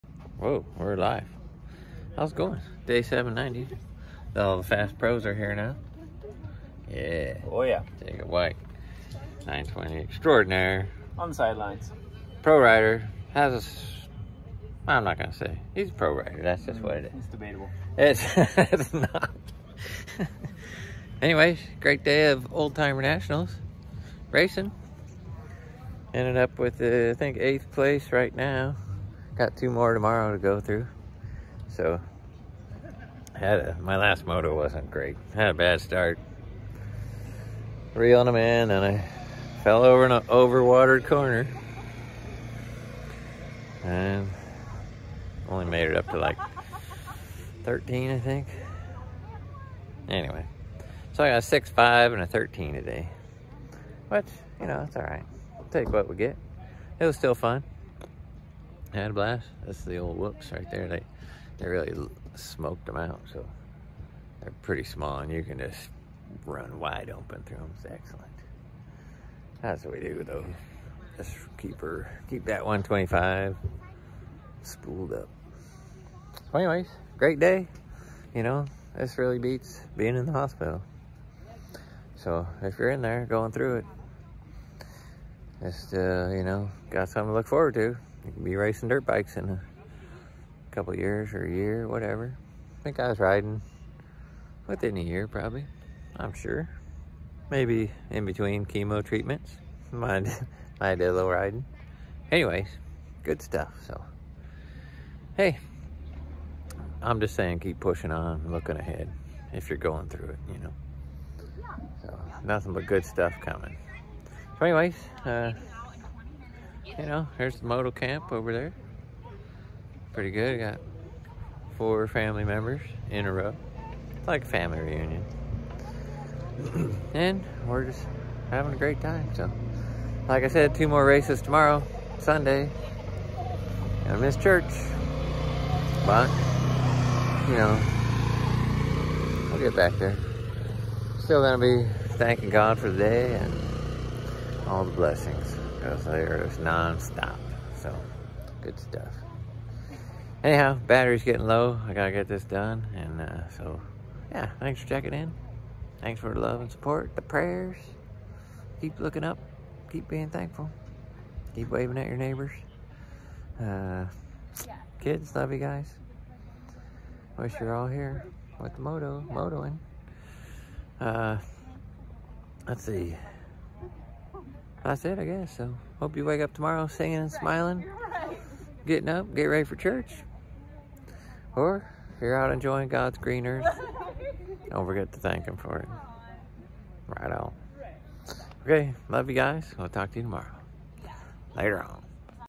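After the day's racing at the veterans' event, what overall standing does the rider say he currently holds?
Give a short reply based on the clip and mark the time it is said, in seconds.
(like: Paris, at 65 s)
8th place, at 27 s.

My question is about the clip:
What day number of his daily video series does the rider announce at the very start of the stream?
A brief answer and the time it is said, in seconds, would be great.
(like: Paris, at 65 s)
790, at 2 s.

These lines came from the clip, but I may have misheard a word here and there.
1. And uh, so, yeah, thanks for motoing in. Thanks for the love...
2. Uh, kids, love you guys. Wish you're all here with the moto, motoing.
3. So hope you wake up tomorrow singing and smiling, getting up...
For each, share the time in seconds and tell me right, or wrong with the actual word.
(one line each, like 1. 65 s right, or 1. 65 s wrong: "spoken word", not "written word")
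1. 152 s wrong: "checking", not "motoing"
2. 163 s right
3. 175 s right.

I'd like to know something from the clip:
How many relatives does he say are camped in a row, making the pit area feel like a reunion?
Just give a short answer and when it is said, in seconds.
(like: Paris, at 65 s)
4, at 121 s.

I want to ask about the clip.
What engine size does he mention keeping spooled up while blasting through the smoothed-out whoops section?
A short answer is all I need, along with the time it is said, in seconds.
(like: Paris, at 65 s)
125, at 72 s.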